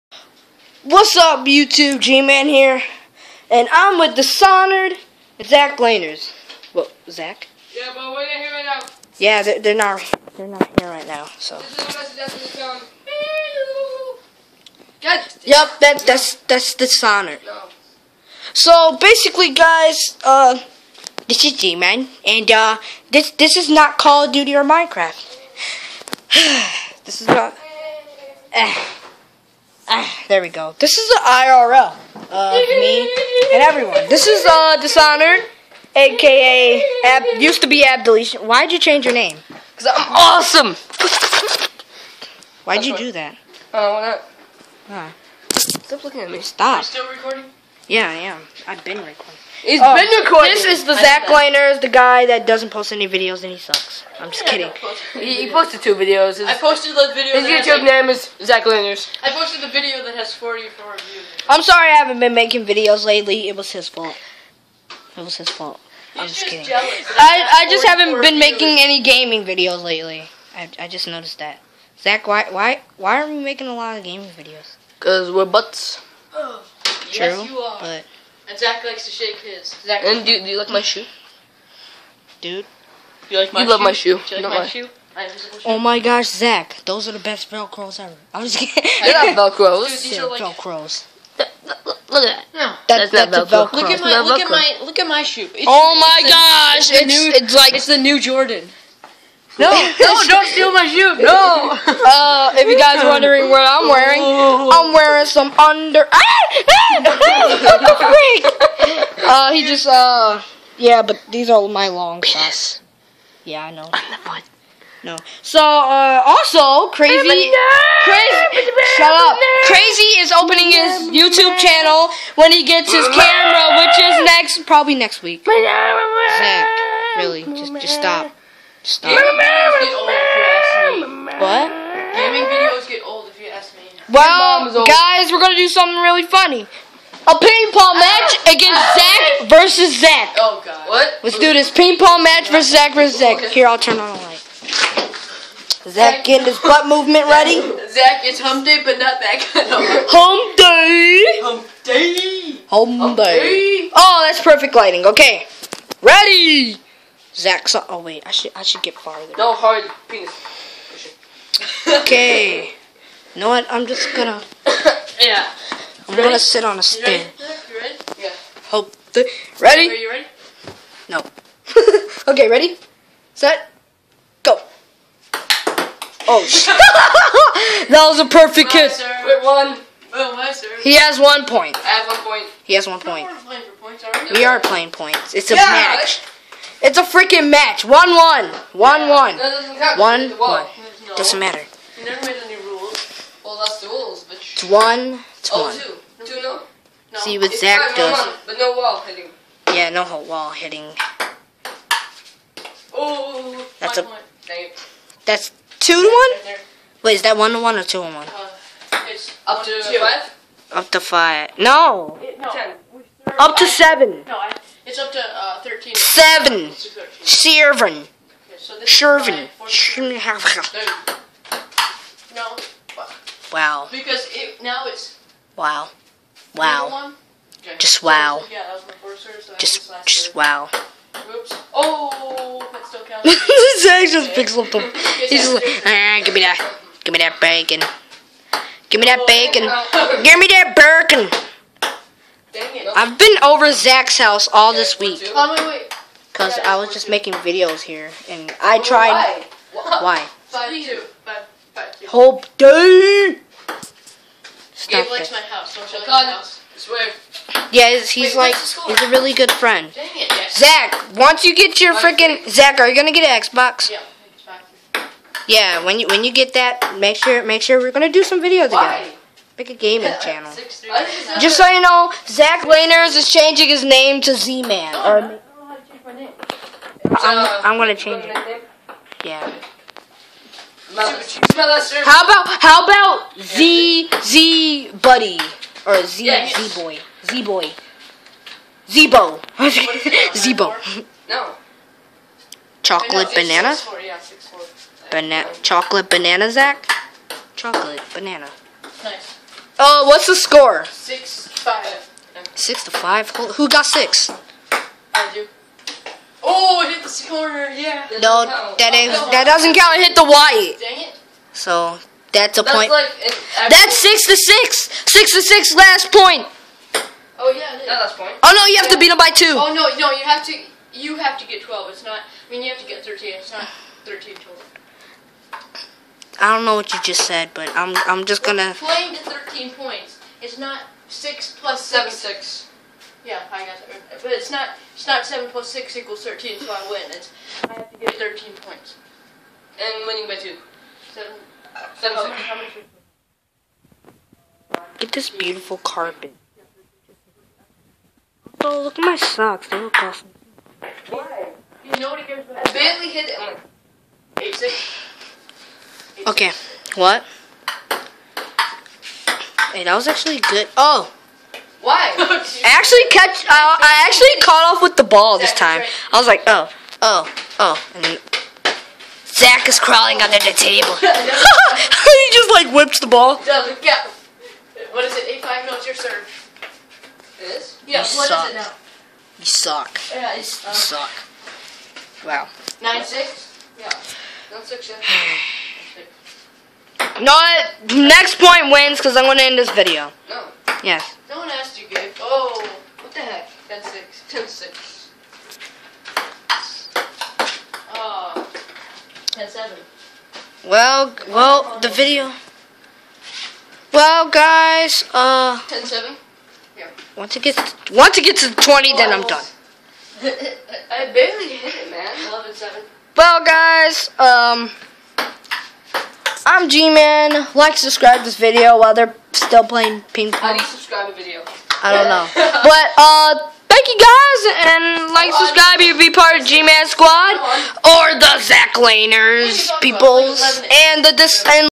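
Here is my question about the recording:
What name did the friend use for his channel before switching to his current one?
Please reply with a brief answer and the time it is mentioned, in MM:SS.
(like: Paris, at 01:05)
Deletion, at 00:37.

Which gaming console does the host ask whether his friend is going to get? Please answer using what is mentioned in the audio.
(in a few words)
Xbox.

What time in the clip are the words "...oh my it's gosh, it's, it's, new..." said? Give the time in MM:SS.
01:35.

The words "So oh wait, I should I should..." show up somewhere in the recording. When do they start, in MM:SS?
02:37.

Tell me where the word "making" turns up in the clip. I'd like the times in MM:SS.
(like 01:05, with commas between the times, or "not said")
01:02, 01:08, 01:13, 04:07.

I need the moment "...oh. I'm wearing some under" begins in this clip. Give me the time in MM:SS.
01:44.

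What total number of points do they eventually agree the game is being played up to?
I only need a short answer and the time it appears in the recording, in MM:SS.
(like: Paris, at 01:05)
13, at 05:28.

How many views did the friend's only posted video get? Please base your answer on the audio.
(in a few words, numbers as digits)
44.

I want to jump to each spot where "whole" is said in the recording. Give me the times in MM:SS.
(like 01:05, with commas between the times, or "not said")
03:20, 04:12.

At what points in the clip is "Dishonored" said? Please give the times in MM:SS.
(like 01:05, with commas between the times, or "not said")
00:04, 00:16, 00:34.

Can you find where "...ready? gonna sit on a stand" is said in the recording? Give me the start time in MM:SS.
02:46.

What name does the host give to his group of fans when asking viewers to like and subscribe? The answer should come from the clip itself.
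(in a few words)
G-Man Squad.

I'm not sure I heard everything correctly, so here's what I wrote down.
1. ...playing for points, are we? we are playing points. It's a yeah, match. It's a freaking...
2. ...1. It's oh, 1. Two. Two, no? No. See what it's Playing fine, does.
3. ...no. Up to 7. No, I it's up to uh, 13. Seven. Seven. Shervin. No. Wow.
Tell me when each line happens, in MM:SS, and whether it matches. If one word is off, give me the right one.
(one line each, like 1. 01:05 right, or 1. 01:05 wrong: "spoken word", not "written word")
1. 03:03 right
2. 03:14 wrong: "Zach", not "Playing"
3. 03:32 right.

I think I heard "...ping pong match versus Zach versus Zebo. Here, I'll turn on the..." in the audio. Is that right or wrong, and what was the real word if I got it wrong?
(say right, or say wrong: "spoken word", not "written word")
wrong: "Zach", not "Zebo".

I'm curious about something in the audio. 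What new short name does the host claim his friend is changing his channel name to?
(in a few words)
Z-Man.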